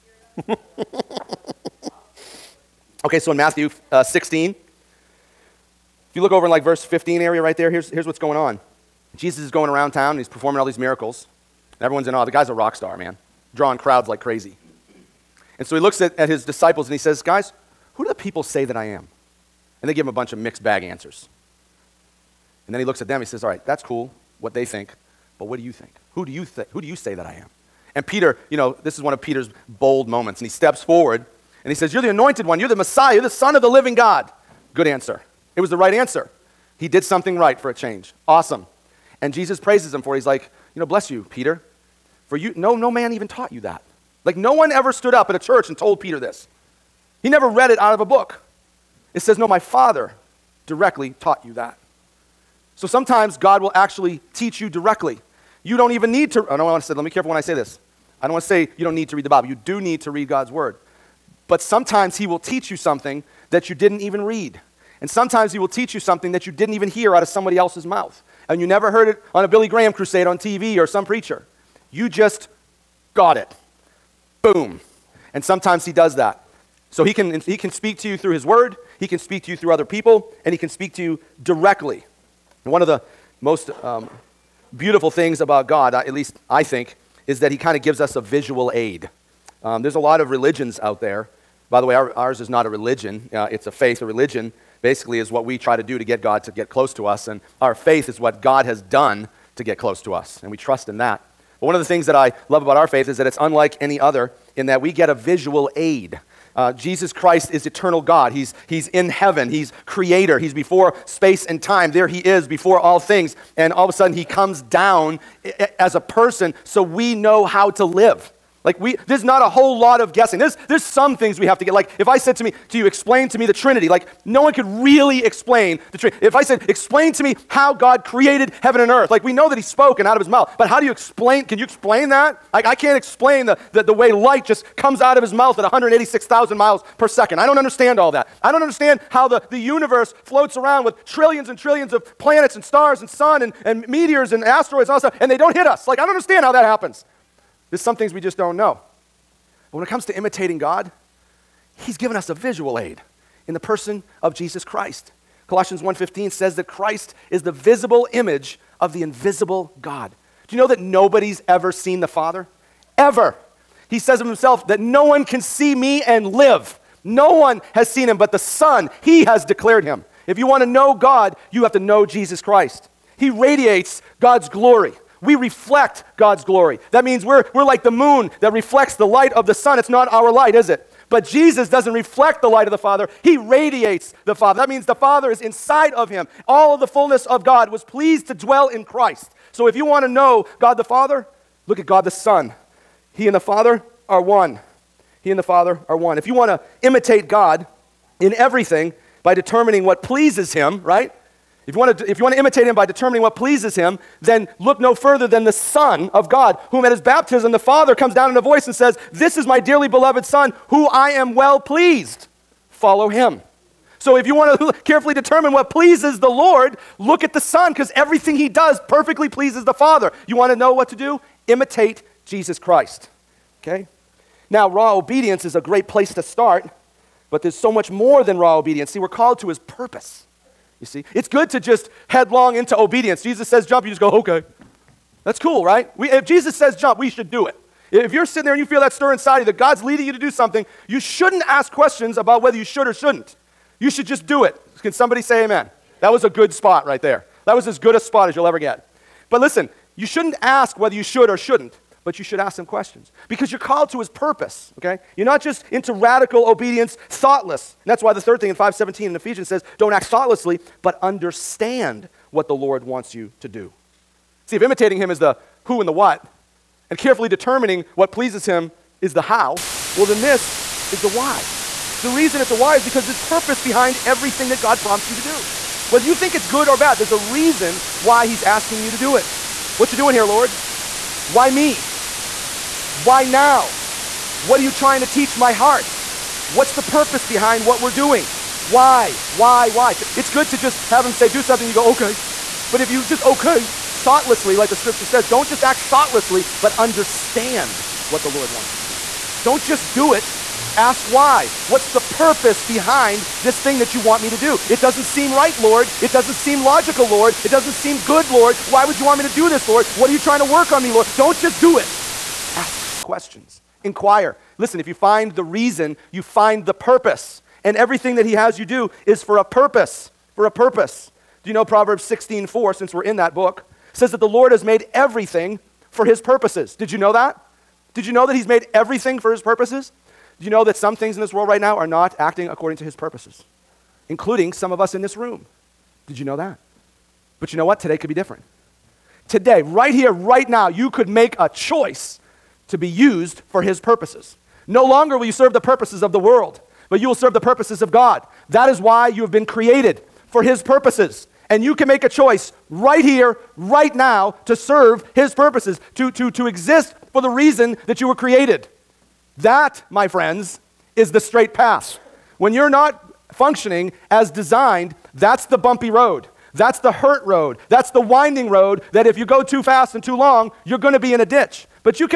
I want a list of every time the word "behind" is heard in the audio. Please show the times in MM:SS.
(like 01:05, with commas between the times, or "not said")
04:33, 04:47, 05:02.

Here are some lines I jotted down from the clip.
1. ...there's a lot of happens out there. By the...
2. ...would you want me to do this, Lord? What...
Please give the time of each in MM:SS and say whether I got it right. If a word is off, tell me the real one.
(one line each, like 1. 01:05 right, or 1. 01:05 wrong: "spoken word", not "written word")
1. 01:29 wrong: "religions", not "happens"
2. 05:08 right.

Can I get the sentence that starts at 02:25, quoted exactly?
Like, I don't understand how that happens.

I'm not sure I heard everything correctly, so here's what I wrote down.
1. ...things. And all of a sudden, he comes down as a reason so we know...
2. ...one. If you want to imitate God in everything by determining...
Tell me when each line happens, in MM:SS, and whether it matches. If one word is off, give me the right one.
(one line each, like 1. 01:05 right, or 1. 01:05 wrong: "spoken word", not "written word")
1. 01:52 wrong: "person", not "reason"
2. 03:15 right.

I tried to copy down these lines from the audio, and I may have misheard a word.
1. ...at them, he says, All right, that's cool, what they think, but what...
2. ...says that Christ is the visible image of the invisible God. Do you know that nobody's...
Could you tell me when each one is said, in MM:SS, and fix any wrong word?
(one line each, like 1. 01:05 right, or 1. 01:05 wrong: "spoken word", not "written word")
1. 00:22 right
2. 02:36 right.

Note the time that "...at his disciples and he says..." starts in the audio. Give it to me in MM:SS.
00:16.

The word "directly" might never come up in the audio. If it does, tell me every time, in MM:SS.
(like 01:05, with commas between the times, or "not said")
00:50, 00:54, 01:21.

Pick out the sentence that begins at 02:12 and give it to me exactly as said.
I, I can't explain the, the, the way light just comes out of his mouth at 186,000 miles per second.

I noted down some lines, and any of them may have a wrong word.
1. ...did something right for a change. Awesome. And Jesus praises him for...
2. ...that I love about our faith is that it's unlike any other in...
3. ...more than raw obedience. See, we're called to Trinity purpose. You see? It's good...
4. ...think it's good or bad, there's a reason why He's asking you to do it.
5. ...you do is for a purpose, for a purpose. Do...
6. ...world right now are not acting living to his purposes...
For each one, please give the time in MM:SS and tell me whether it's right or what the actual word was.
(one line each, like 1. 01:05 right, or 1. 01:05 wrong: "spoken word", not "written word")
1. 00:36 right
2. 01:42 right
3. 03:47 wrong: "His", not "Trinity"
4. 04:36 right
5. 05:18 right
6. 05:31 wrong: "according", not "living".